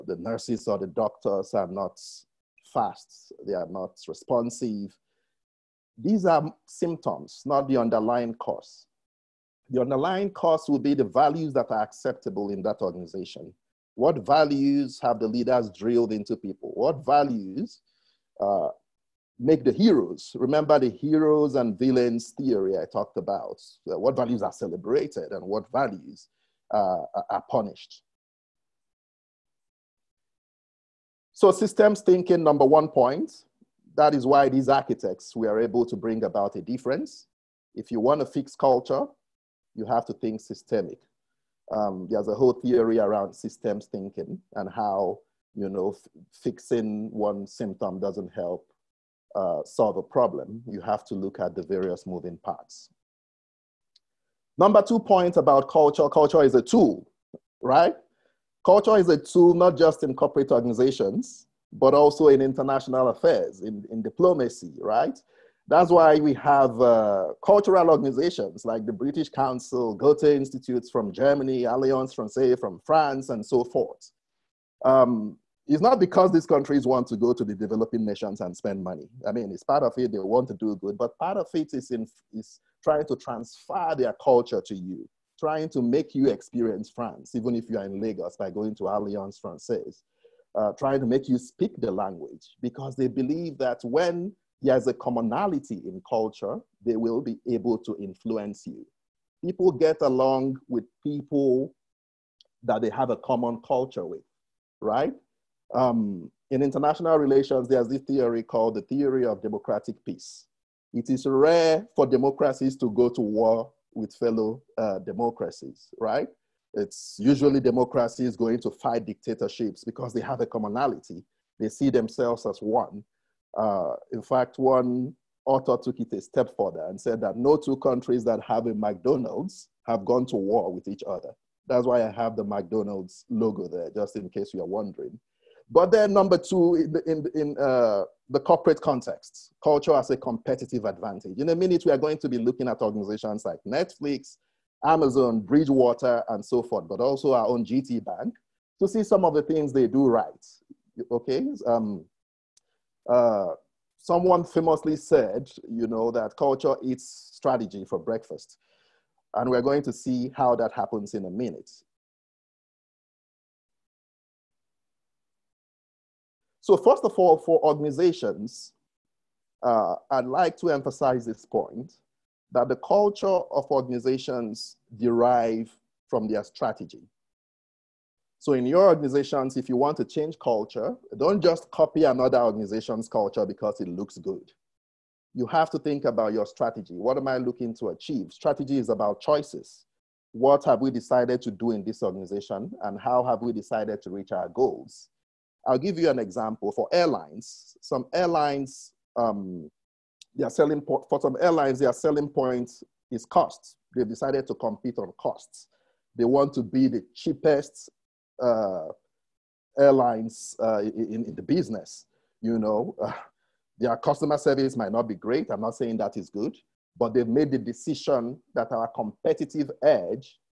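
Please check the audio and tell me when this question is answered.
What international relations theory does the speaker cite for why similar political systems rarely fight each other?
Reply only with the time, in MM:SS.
01:48.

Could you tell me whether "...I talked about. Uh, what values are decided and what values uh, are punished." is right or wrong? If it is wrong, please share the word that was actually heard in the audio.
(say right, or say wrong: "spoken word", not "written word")
wrong: "celebrated", not "decided".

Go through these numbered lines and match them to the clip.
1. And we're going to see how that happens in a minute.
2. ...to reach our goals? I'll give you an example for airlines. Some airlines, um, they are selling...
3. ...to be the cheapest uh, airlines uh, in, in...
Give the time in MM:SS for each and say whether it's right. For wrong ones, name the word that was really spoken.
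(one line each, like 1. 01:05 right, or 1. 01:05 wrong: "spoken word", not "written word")
1. 02:39 right
2. 03:14 right
3. 03:26 right.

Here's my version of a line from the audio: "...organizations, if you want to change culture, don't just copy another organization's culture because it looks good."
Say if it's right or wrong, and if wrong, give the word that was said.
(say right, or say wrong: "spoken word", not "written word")
right.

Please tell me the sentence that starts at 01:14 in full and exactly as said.
Um, it's not because these countries want to go to the developing nations and spend money.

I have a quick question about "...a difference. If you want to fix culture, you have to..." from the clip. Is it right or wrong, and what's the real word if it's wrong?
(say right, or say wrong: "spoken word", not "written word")
right.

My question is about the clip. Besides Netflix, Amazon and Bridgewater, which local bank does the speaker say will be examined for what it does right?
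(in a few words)
GT Bank.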